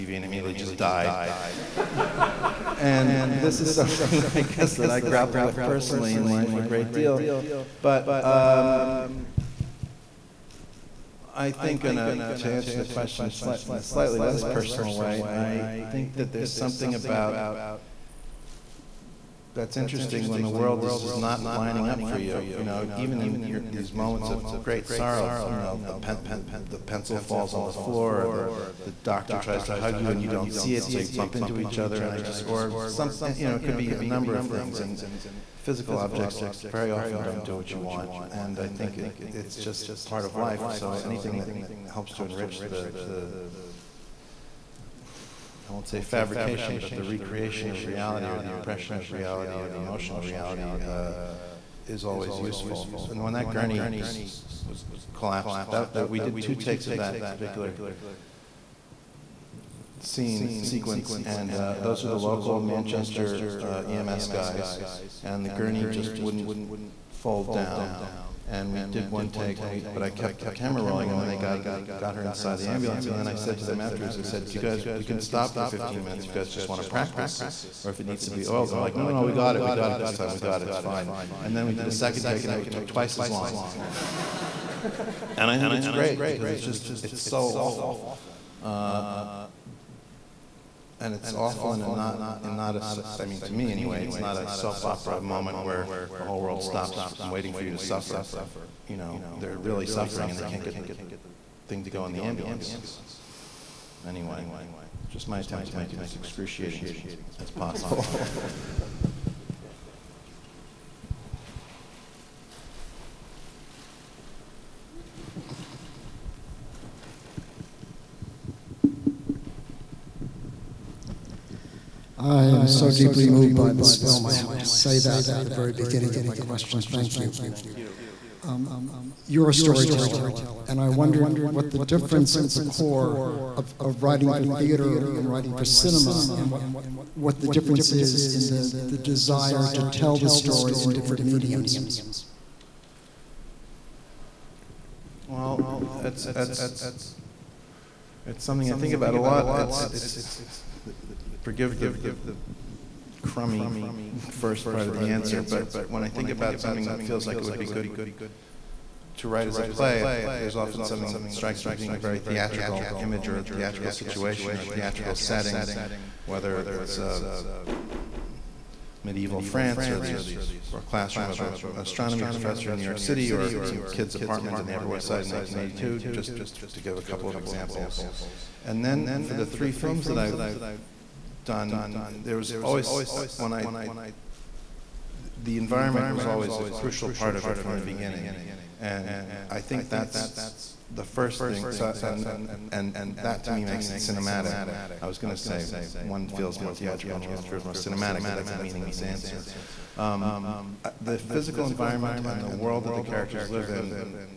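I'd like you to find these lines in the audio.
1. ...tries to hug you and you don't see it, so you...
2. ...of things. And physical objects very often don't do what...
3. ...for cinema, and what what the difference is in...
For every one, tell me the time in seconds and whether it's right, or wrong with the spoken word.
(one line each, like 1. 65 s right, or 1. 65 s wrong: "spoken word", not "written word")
1. 29 s right
2. 34 s right
3. 135 s right.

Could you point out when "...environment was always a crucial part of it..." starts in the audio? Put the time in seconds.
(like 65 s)
185 s.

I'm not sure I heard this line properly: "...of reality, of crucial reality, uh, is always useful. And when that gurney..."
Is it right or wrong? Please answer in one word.
wrong.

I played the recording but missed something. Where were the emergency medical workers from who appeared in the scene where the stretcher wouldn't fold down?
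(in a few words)
Manchester.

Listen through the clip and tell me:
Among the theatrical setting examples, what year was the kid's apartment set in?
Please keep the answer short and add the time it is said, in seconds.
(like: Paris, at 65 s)
1982, at 175 s.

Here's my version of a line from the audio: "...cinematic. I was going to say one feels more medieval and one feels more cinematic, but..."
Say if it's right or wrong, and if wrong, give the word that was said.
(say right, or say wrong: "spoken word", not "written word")
wrong: "theatrical", not "medieval".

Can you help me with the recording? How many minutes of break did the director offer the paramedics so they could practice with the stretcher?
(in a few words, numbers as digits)
15.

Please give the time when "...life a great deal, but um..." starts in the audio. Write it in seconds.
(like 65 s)
6 s.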